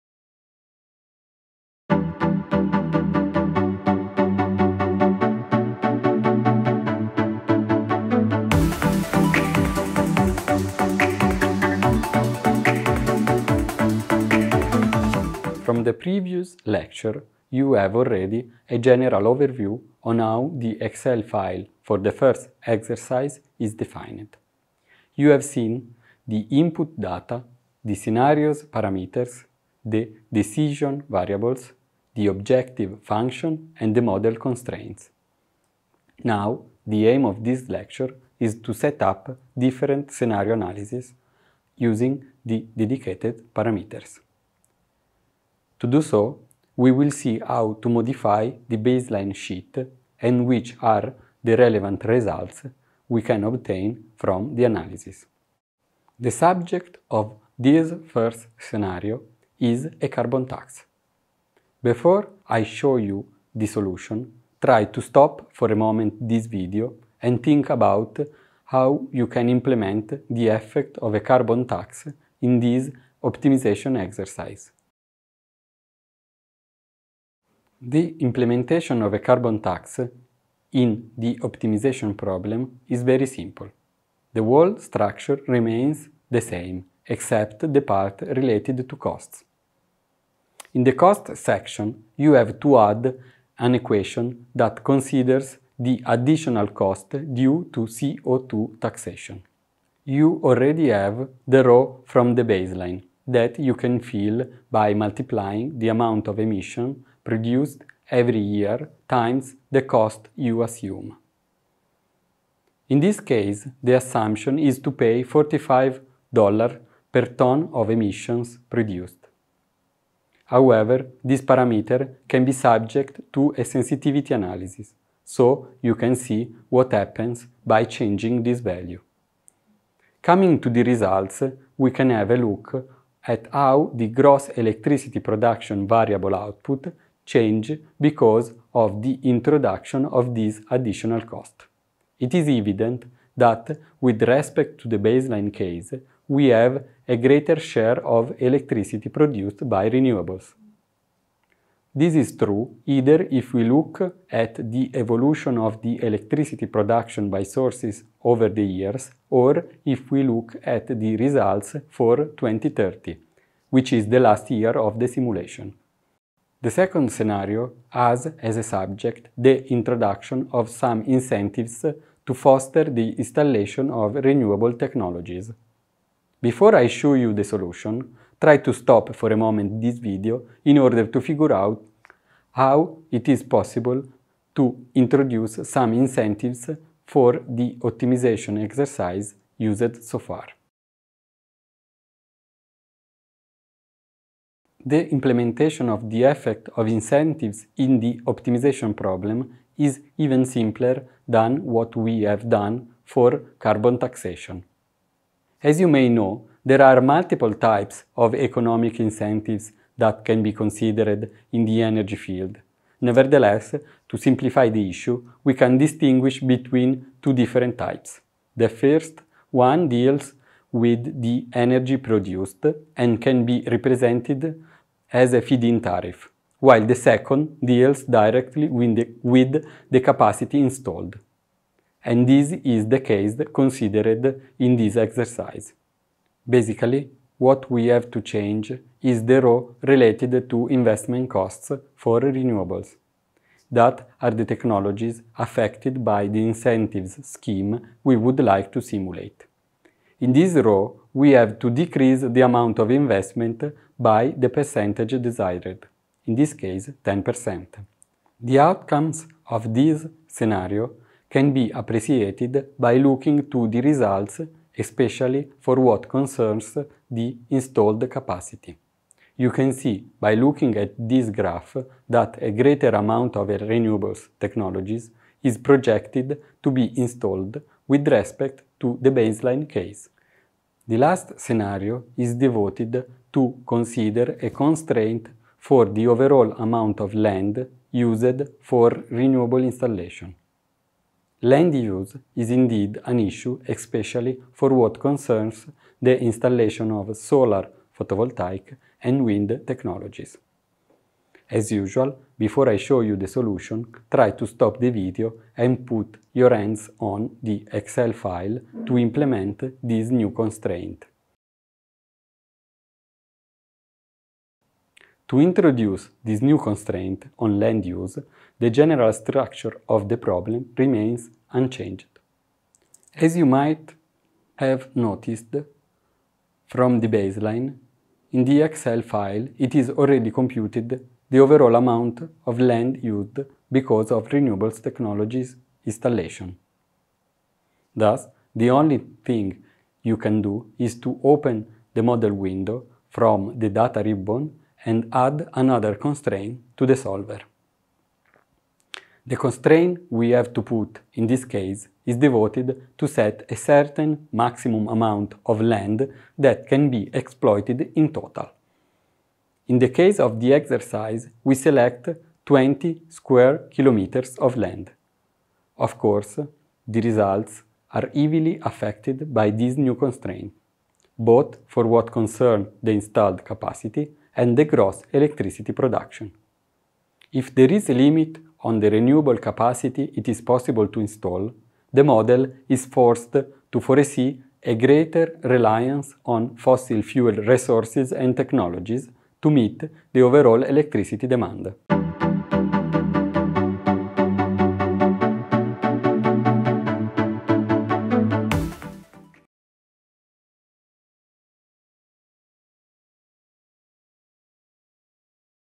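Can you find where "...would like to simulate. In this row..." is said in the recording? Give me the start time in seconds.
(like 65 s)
248 s.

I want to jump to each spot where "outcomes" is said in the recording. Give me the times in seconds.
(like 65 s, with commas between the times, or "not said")
258 s.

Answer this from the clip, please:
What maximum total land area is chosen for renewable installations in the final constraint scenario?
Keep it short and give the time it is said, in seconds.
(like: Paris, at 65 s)
20 square kilometers, at 362 s.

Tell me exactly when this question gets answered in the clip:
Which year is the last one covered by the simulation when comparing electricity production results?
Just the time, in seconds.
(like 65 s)
162 s.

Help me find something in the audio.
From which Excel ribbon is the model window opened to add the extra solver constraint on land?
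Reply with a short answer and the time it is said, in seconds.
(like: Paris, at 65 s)
data ribbon, at 343 s.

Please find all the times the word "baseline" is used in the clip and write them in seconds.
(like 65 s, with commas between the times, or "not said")
48 s, 102 s, 144 s, 279 s, 327 s.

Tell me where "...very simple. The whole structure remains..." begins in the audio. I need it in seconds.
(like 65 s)
83 s.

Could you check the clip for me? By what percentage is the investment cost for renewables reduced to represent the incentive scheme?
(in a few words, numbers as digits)
10%.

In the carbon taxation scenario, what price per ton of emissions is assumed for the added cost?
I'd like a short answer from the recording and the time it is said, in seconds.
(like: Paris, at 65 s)
$45, at 115 s.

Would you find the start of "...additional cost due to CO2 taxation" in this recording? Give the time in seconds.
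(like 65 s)
96 s.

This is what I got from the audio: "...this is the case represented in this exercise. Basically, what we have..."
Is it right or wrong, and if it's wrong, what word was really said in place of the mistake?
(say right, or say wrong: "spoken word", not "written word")
wrong: "considered", not "represented".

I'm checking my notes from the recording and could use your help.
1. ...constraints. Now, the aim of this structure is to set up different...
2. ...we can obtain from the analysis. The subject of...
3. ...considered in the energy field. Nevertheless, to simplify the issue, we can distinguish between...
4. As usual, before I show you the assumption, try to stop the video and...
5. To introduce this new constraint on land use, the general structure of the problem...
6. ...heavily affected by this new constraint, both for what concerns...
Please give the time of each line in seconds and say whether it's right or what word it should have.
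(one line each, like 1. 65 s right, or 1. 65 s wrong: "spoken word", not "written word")
1. 34 s wrong: "lecture", not "structure"
2. 53 s right
3. 210 s right
4. 301 s wrong: "solution", not "assumption"
5. 315 s right
6. 368 s right.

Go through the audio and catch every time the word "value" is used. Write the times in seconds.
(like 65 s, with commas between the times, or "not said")
128 s.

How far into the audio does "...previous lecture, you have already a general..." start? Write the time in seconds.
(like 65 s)
15 s.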